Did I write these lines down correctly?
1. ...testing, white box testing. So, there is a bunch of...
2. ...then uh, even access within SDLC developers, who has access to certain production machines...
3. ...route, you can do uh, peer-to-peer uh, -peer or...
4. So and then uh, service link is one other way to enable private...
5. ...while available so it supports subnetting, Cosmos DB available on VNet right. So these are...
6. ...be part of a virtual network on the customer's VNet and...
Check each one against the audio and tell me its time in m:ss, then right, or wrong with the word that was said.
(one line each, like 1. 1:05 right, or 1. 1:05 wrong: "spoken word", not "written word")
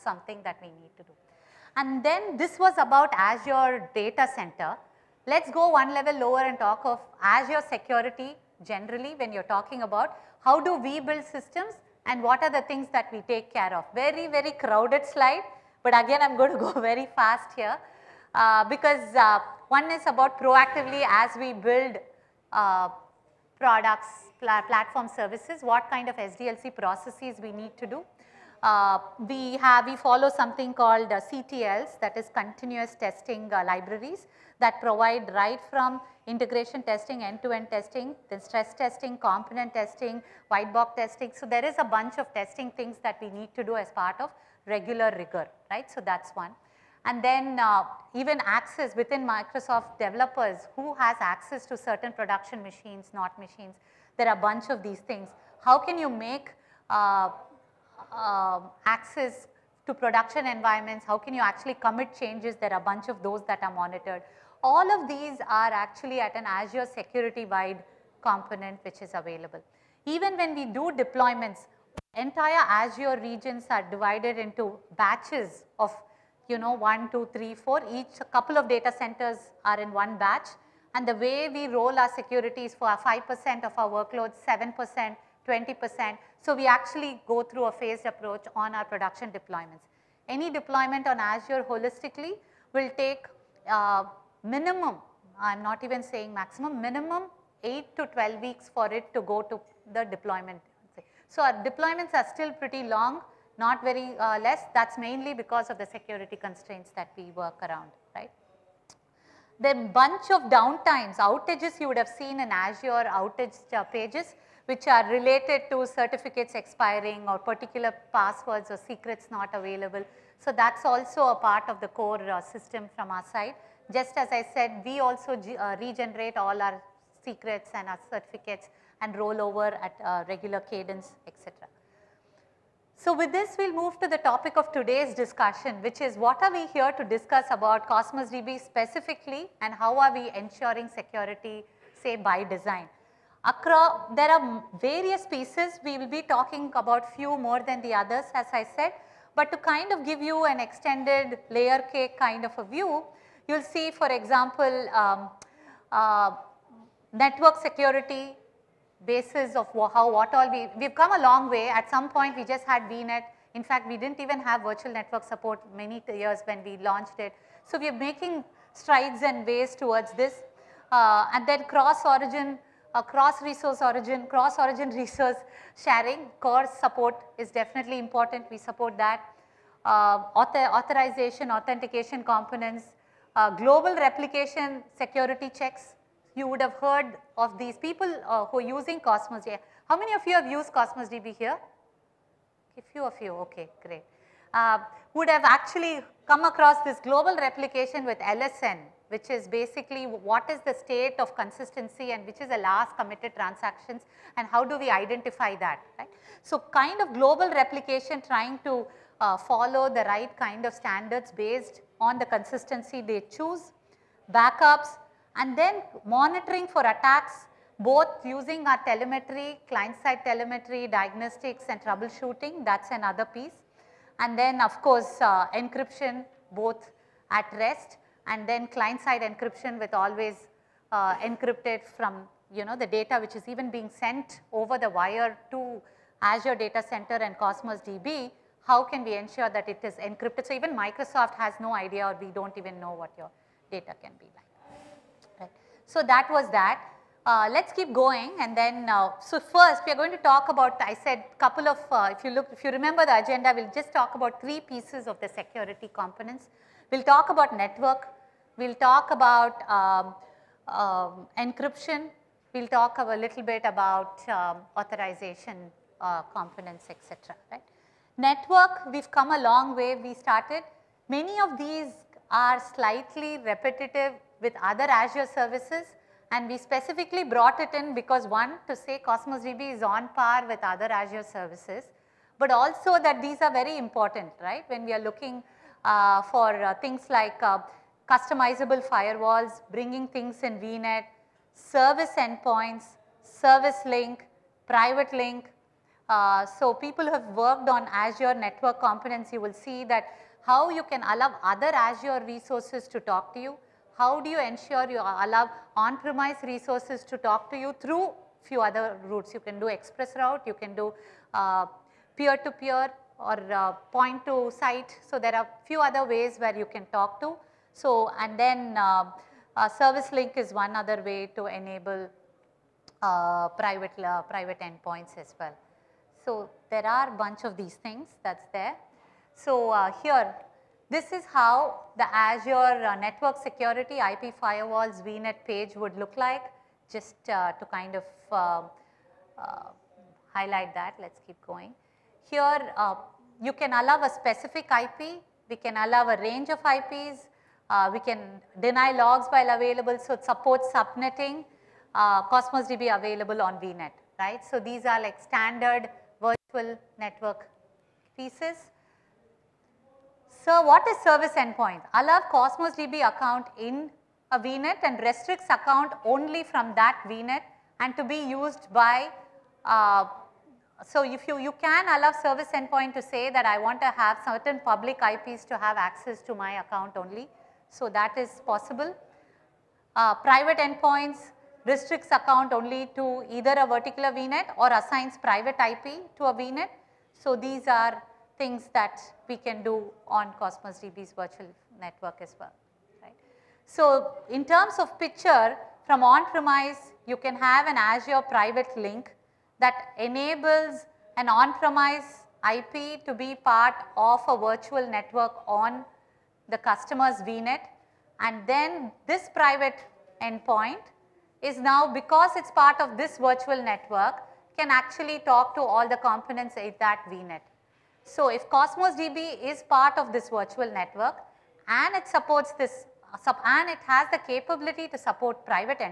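1. 0:39 right
2. 0:47 wrong: "Microsoft", not "SDLC"
3. 5:10 right
4. 5:17 right
5. 5:49 right
6. 6:43 right.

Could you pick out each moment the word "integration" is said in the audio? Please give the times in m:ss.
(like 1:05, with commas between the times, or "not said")
0:36.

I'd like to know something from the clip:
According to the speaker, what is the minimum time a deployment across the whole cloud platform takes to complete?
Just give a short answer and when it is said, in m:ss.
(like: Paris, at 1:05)
8 to 12 weeks, at 1:37.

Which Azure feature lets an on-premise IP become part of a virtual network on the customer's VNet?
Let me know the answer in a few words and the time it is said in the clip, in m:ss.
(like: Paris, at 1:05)
Azure Private Link, at 6:37.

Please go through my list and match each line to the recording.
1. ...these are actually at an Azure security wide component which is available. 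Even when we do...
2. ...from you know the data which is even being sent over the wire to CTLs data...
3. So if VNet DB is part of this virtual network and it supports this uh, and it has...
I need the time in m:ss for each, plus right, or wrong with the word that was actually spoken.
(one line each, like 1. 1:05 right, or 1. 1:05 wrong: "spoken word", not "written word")
1. 1:05 right
2. 3:51 wrong: "Azure", not "CTLs"
3. 6:58 wrong: "Cosmos", not "VNet".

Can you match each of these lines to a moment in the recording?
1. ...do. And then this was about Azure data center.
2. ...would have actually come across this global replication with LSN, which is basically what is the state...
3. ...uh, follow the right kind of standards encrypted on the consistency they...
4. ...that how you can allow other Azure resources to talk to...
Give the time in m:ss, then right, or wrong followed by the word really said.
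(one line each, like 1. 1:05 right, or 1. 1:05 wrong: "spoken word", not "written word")
1. 0:01 right
2. 3:15 right
3. 3:29 wrong: "based", not "encrypted"
4. 4:59 right.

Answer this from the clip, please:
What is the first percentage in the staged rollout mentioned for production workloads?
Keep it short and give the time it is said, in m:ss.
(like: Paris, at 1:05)
5%, at 1:22.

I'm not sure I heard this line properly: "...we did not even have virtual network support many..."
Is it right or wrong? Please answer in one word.
right.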